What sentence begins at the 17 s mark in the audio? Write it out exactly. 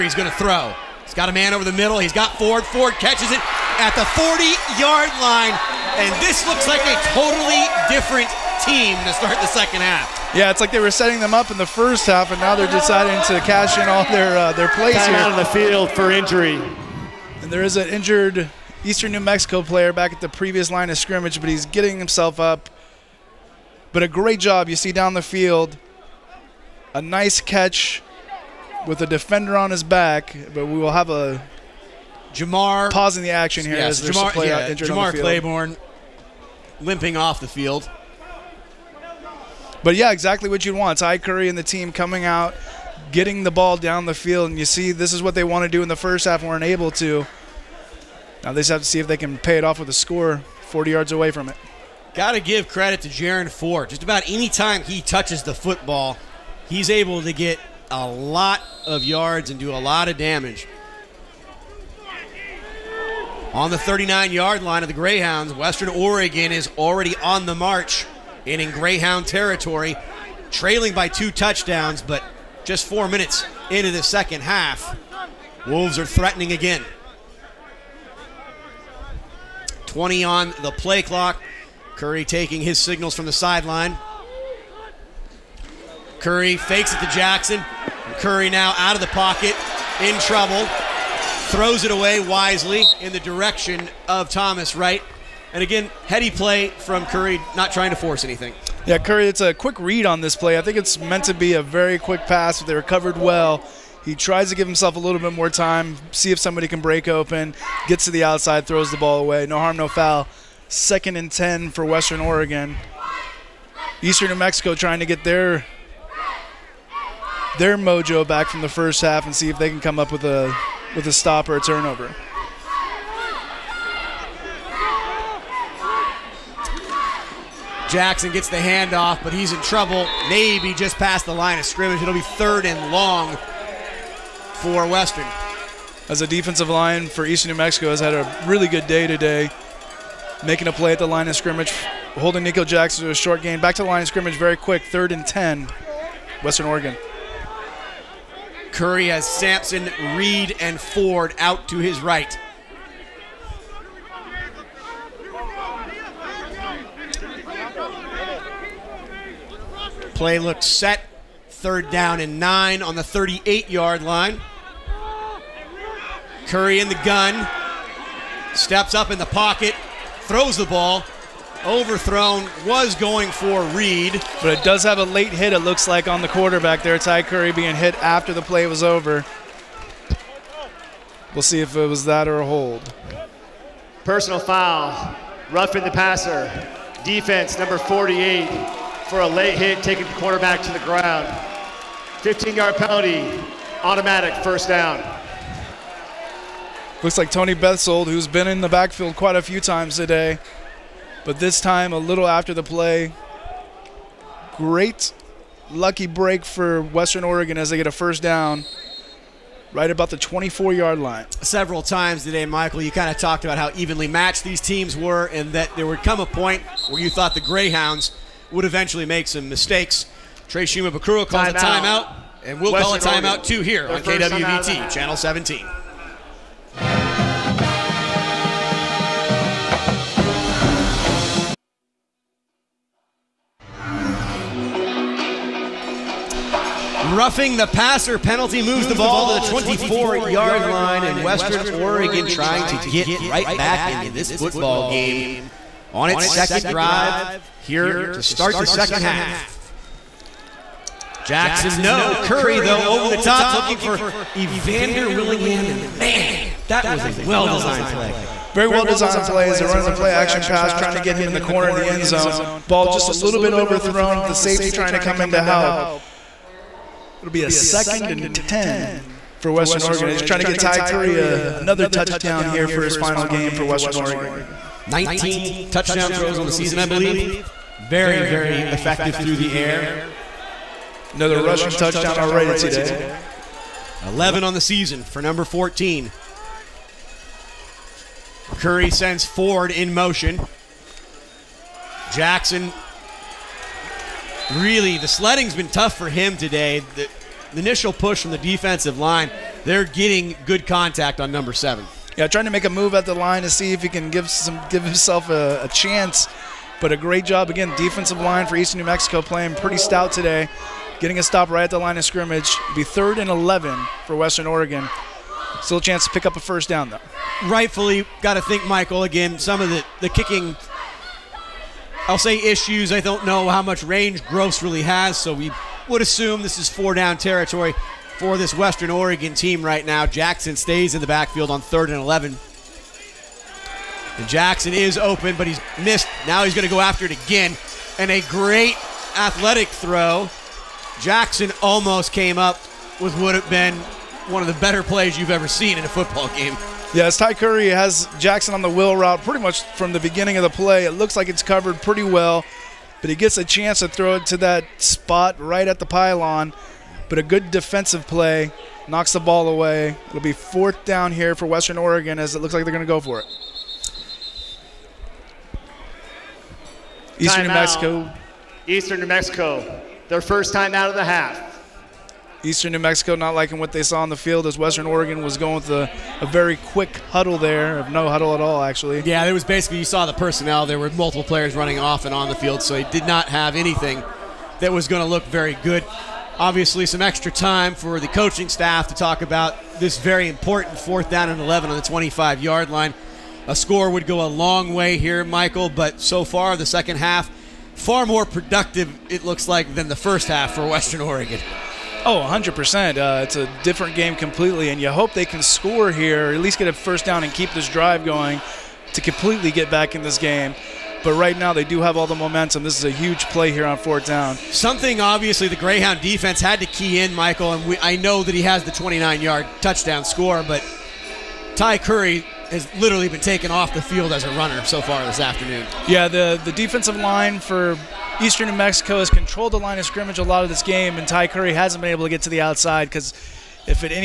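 And there is an injured Eastern New Mexico player back at the previous line of scrimmage, but he's getting himself up.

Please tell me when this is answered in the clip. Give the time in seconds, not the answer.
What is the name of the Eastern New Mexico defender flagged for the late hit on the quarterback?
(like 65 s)
197 s.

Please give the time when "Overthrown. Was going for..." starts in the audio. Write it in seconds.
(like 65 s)
171 s.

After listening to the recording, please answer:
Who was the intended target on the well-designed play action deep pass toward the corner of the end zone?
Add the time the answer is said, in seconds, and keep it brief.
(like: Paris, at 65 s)
Evander Willingham, at 254 s.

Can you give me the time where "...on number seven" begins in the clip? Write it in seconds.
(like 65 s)
301 s.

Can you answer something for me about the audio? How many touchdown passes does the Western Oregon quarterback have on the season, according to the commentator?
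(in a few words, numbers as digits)
19.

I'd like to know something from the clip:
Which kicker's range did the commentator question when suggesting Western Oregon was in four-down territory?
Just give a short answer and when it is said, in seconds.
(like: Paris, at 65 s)
Gross, at 324 s.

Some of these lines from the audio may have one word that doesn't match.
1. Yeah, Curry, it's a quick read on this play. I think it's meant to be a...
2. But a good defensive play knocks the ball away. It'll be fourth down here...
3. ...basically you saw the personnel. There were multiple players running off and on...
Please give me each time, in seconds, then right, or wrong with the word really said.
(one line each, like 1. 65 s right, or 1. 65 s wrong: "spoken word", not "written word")
1. 98 s right
2. 357 s right
3. 379 s right.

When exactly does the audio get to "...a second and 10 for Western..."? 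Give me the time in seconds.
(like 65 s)
267 s.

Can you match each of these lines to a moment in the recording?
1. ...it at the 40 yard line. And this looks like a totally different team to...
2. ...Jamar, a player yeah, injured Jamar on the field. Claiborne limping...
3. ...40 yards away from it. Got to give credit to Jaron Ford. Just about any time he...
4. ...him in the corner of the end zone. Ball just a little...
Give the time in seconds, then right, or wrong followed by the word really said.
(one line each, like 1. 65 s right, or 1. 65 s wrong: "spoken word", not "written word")
1. 3 s right
2. 34 s right
3. 50 s right
4. 261 s right.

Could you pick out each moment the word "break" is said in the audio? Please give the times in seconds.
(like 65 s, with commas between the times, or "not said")
106 s, 206 s.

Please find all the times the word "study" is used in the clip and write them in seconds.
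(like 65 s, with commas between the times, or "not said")
not said.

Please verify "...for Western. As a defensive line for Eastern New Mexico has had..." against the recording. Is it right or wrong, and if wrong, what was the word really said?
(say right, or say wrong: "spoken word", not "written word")
right.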